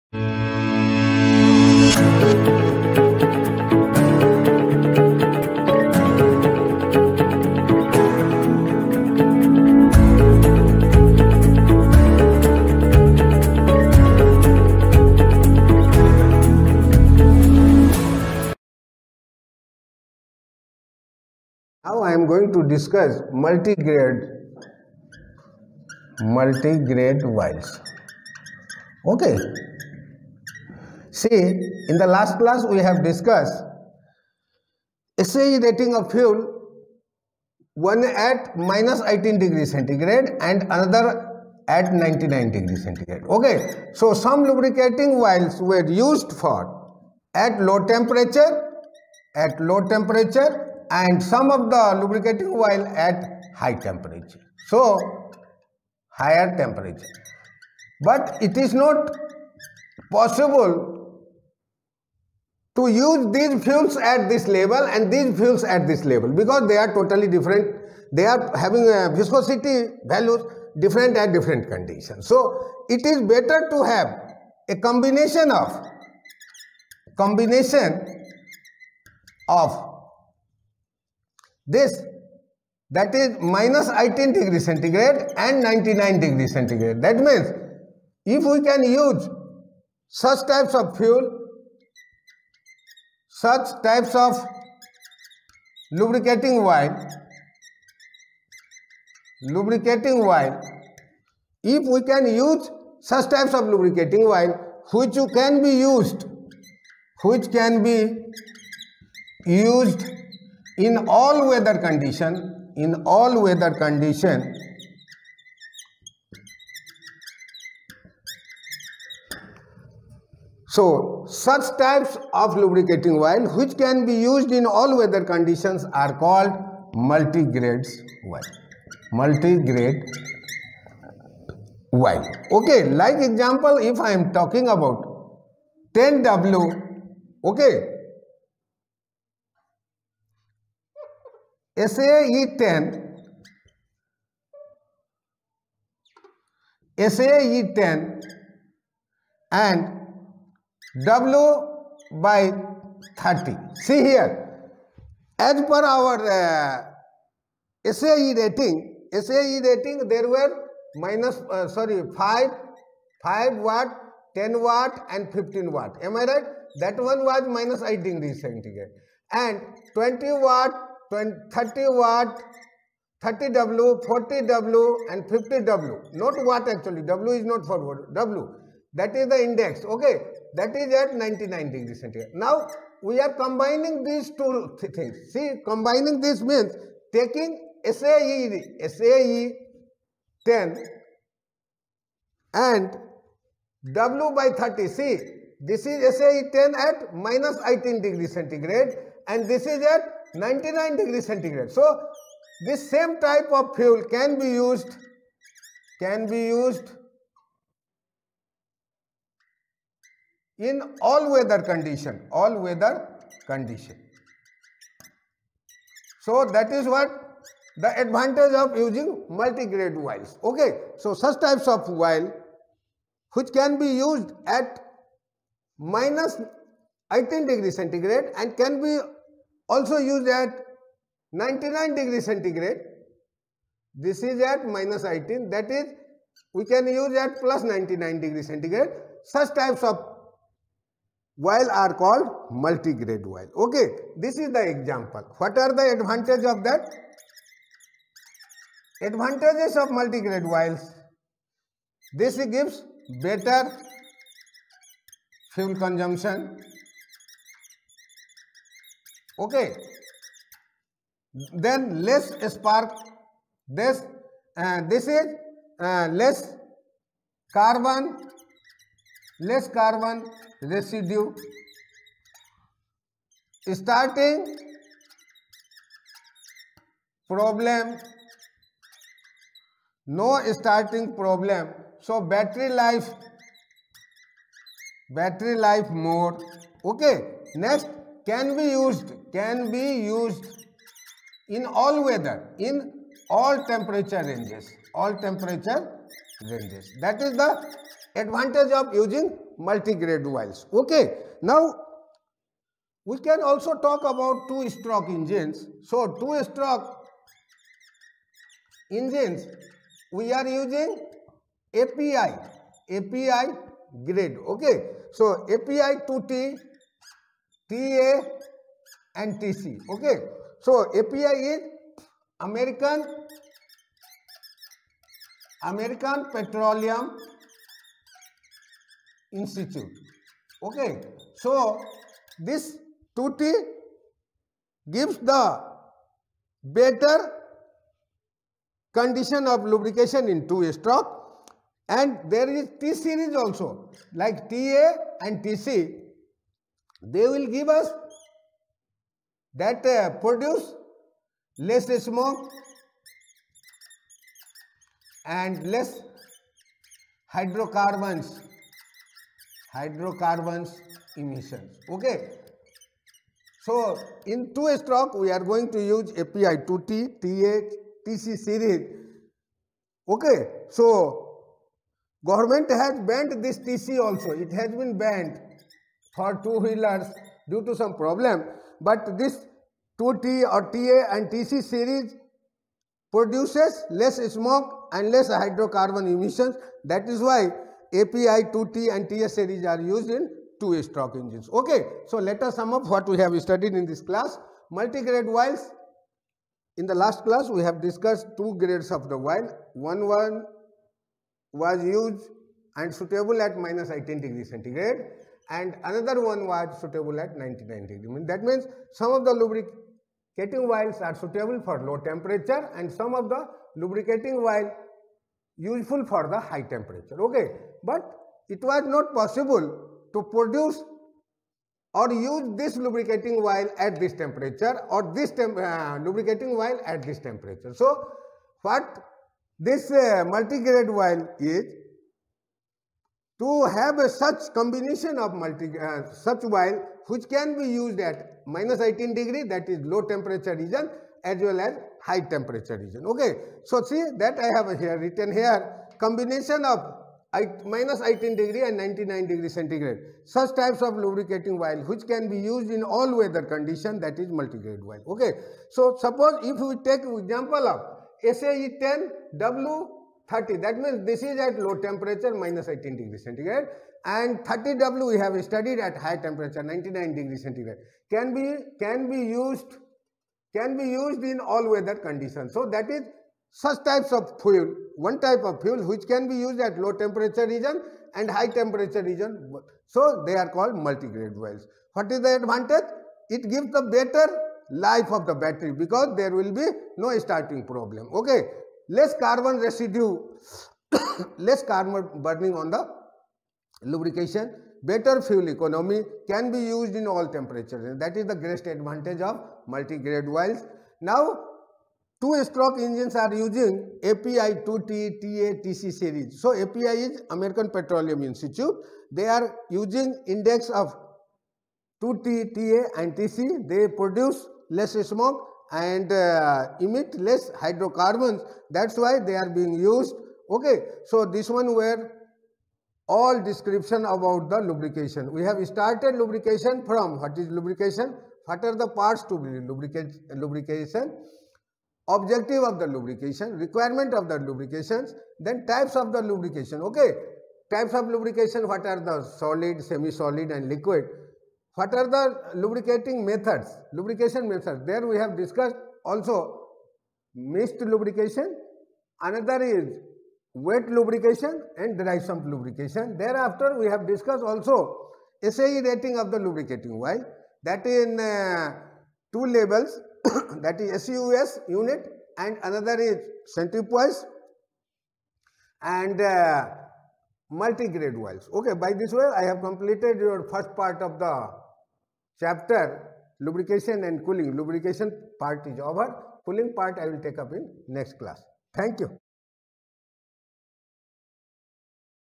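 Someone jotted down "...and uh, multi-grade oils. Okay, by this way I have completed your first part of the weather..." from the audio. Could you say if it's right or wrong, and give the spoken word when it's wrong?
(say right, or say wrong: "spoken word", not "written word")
wrong: "chapter", not "weather".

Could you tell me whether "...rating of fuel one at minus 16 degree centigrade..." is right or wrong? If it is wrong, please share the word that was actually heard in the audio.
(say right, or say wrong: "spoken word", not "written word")
wrong: "18", not "16".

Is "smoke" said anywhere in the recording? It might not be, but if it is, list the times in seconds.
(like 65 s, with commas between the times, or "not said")
352 s, 384 s, 515 s.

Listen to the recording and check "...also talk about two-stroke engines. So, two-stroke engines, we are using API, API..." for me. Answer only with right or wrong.
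right.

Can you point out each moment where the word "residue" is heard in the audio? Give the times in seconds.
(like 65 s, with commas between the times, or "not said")
270 s, 489 s.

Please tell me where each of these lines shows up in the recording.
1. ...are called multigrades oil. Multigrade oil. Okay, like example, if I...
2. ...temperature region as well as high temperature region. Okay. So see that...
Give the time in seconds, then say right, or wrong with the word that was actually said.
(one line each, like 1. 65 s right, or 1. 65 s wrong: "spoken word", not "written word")
1. 125 s right
2. 440 s right.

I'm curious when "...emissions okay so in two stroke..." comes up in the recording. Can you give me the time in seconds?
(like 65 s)
361 s.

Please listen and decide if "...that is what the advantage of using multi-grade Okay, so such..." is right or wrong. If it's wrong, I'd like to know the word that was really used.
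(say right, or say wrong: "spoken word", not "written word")
right.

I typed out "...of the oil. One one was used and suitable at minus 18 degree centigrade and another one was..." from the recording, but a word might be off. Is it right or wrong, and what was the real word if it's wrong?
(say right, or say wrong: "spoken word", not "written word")
right.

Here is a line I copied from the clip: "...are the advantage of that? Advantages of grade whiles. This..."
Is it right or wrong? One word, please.
wrong.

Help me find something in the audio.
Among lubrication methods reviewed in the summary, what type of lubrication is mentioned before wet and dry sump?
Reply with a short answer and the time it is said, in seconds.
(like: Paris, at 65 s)
Mist lubrication, at 547 s.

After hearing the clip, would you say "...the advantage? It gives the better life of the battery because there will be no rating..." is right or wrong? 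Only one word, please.
wrong.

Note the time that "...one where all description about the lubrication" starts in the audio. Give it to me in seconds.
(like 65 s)
521 s.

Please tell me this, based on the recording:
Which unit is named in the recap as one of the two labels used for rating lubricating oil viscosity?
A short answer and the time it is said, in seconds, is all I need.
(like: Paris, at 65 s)
SUS unit, at 561 s.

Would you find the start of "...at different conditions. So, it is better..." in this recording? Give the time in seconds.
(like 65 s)
71 s.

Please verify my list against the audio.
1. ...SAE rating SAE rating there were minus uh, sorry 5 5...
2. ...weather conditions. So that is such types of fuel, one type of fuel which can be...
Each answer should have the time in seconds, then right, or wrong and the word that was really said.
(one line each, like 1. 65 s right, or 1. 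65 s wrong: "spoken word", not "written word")
1. 157 s right
2. 471 s right.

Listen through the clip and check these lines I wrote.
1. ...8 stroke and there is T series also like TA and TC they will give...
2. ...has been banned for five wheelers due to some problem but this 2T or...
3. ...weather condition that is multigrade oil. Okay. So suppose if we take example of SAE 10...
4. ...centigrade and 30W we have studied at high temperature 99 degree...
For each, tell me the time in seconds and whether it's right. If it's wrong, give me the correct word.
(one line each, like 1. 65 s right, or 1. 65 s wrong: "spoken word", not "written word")
1. 340 s wrong: "2", not "8"
2. 374 s wrong: "two", not "five"
3. 453 s right
4. 463 s right.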